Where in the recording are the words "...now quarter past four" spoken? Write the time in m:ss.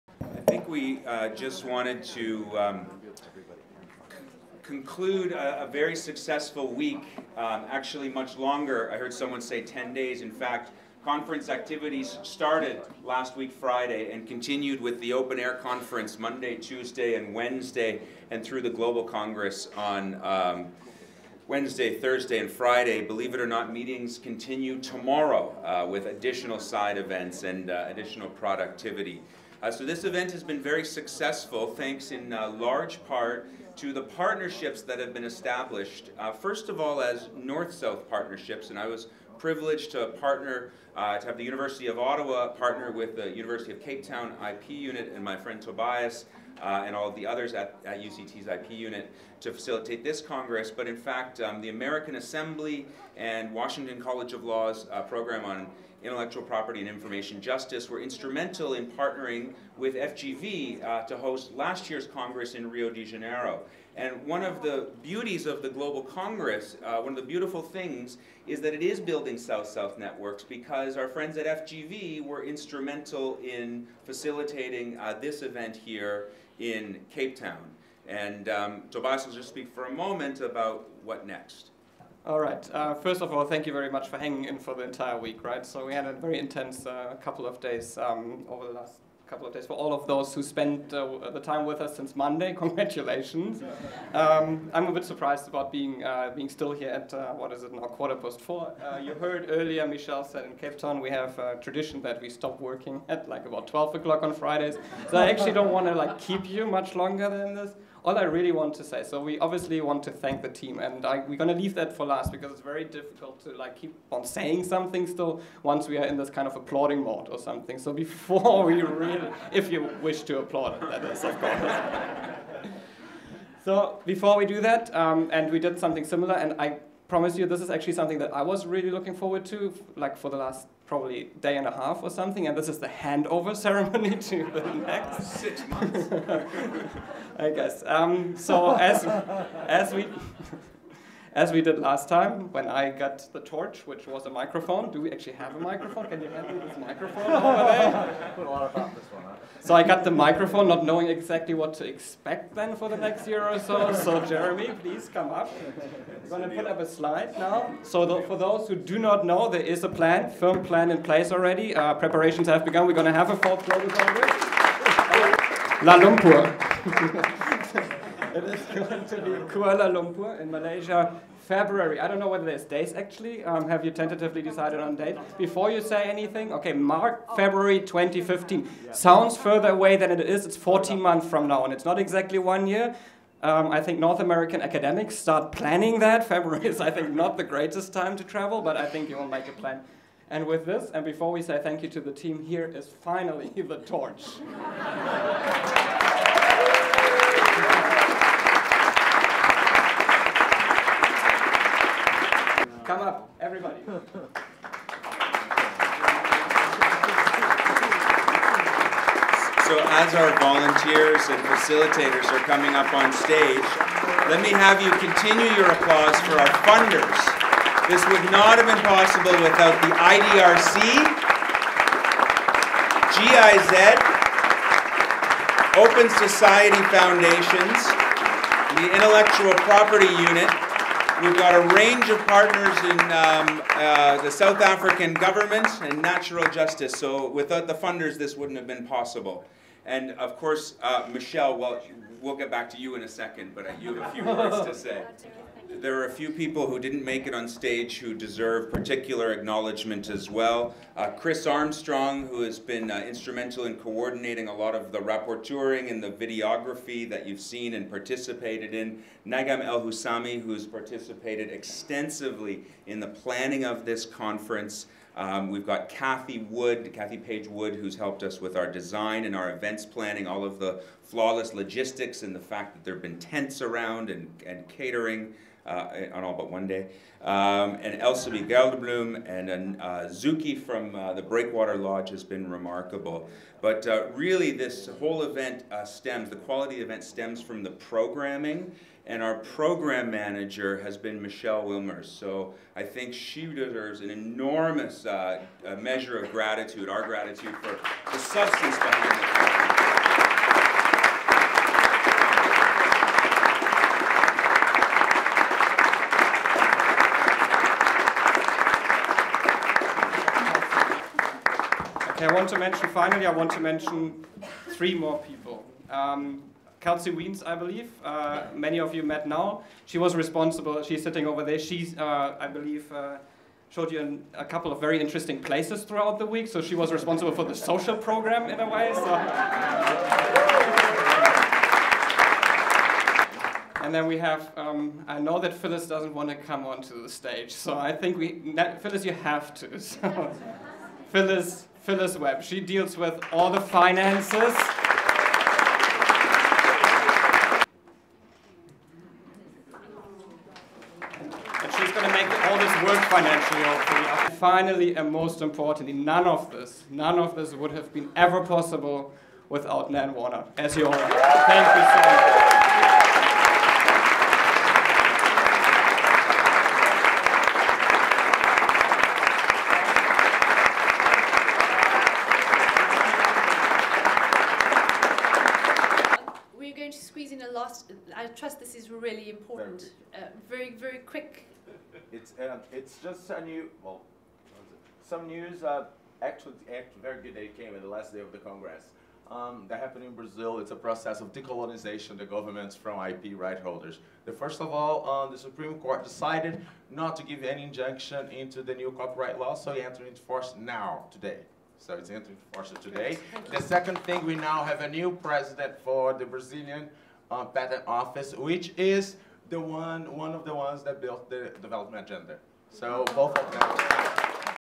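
1:37.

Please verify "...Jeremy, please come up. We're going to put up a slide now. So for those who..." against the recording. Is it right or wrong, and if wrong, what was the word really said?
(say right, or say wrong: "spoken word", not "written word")
right.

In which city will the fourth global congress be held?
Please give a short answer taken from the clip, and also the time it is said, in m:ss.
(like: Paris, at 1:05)
Kuala Lumpur, at 2:49.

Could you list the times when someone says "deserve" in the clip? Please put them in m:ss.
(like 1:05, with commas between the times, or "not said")
4:08, 4:53.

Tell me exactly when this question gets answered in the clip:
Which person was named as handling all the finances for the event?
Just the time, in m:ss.
5:41.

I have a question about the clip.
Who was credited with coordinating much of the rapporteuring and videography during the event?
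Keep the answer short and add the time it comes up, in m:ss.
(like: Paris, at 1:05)
Chris Armstrong, at 4:11.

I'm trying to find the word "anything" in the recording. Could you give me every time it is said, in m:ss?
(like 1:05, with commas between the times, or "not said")
2:56.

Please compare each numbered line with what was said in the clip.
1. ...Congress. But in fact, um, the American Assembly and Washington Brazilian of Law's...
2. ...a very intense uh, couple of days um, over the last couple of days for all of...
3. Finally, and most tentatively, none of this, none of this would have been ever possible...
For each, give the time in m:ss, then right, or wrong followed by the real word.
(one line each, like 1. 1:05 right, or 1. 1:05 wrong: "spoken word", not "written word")
1. 0:50 wrong: "College", not "Brazilian"
2. 1:26 right
3. 5:54 wrong: "importantly", not "tentatively".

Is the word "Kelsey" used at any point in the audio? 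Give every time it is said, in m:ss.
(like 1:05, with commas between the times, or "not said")
5:16.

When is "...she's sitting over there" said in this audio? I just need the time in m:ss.
5:20.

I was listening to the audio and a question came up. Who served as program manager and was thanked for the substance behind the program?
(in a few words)
Michelle Willmers.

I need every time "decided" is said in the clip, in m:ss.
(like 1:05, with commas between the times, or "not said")
2:54, 6:36.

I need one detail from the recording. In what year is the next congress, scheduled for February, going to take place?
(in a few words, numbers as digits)
2015.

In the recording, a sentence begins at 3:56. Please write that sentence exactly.
So without the funders, this wouldn't have been possible.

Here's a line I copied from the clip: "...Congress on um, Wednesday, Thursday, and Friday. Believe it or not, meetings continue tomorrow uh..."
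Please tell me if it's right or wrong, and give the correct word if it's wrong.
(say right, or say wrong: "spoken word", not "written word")
right.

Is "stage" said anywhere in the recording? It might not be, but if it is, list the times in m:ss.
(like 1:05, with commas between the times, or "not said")
3:33, 4:07, 5:37.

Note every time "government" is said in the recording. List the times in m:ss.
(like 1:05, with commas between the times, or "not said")
3:55, 6:32.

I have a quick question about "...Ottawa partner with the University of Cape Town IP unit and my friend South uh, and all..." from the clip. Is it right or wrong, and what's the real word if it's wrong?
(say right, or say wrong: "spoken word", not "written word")
wrong: "Tobias", not "South".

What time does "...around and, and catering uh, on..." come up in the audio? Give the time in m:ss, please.
4:33.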